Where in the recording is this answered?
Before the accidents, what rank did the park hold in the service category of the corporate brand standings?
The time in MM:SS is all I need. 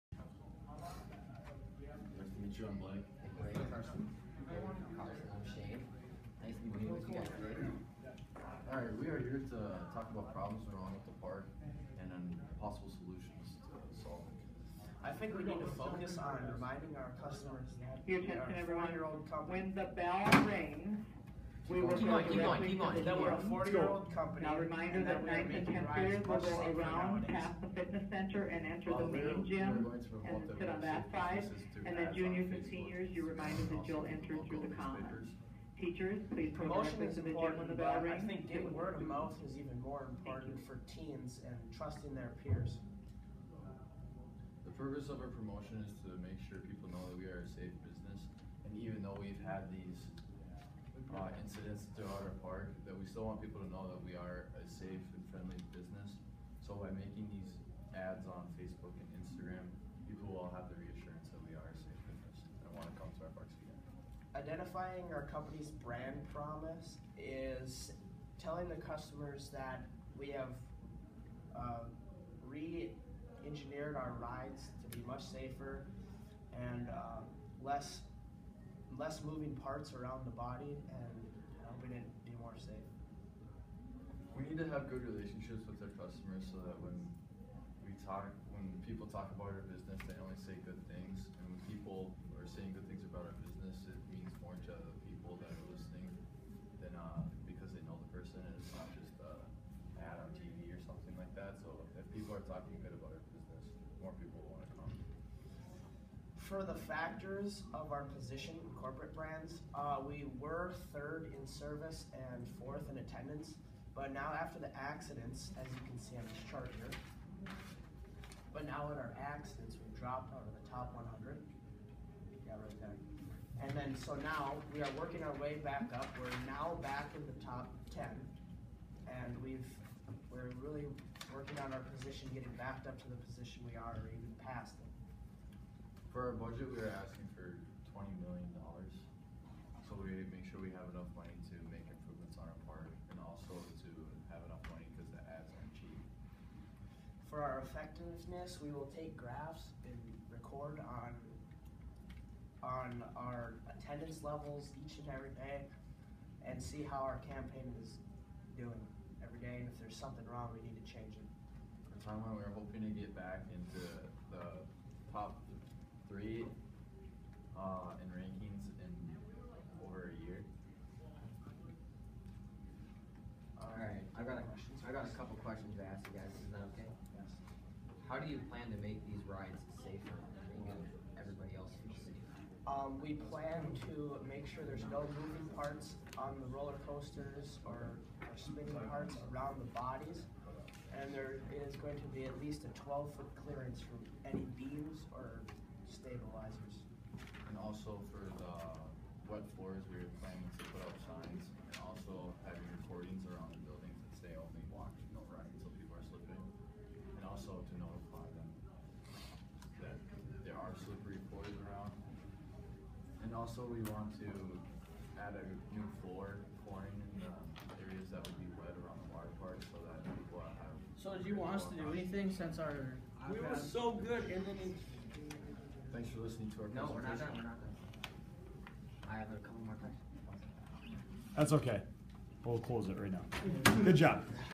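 01:50.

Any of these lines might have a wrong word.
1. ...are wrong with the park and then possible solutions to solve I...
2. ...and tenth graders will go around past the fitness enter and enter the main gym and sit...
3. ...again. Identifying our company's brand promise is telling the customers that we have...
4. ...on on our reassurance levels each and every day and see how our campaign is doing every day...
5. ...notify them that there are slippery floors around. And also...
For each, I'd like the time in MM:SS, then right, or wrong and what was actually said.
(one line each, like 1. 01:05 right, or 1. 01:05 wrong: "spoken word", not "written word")
1. 00:10 right
2. 00:25 wrong: "center", not "enter"
3. 01:03 right
4. 02:30 wrong: "attendance", not "reassurance"
5. 03:27 right.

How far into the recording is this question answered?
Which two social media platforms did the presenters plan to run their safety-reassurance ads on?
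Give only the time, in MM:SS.
00:58.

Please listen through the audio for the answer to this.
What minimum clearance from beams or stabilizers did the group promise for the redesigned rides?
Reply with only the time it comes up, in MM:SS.
03:12.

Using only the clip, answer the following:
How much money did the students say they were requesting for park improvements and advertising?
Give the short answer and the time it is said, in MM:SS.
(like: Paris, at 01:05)
$20 million, at 02:17.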